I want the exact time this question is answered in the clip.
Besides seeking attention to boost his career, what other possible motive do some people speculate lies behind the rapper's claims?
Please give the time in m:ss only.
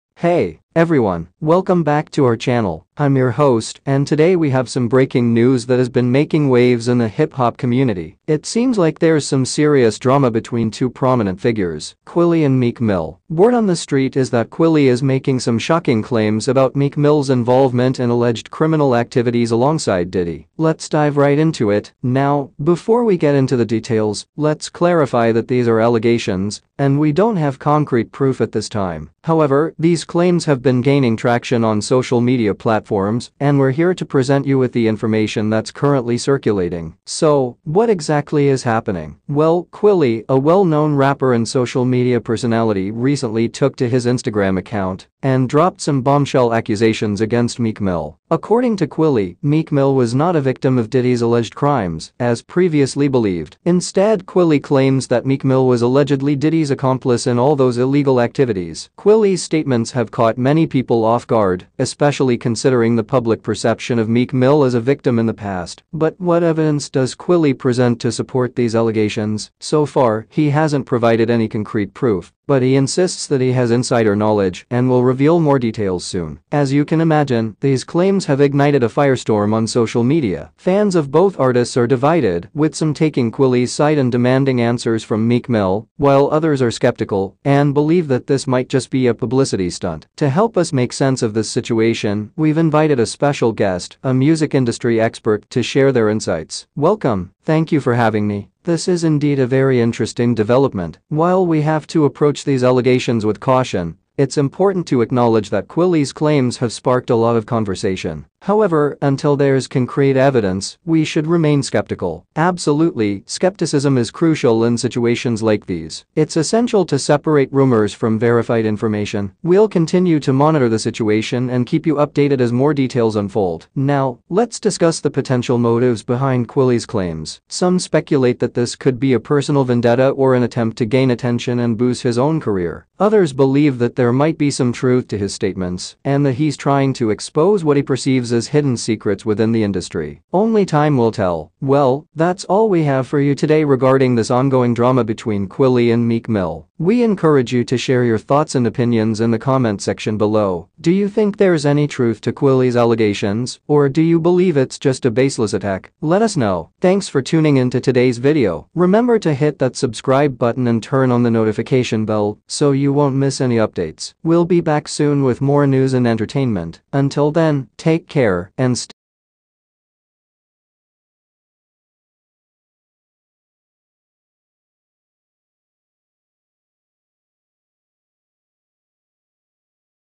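2:09.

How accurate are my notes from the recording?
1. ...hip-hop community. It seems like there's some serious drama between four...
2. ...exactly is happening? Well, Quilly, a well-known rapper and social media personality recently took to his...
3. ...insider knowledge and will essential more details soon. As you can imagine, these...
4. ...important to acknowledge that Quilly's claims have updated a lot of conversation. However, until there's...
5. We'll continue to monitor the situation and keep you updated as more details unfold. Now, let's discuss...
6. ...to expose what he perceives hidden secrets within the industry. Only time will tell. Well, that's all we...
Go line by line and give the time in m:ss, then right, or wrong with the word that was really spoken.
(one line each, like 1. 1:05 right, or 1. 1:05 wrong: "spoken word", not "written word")
1. 0:07 wrong: "two", not "four"
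2. 0:37 right
3. 1:13 wrong: "reveal", not "essential"
4. 1:44 wrong: "sparked", not "updated"
5. 1:59 right
6. 2:16 right.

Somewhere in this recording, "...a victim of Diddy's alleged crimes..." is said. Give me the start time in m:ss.
0:50.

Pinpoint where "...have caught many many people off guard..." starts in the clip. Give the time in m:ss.
0:59.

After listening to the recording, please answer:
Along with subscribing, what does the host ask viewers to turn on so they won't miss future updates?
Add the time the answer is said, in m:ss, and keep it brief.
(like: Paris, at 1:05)
The notification bell, at 2:41.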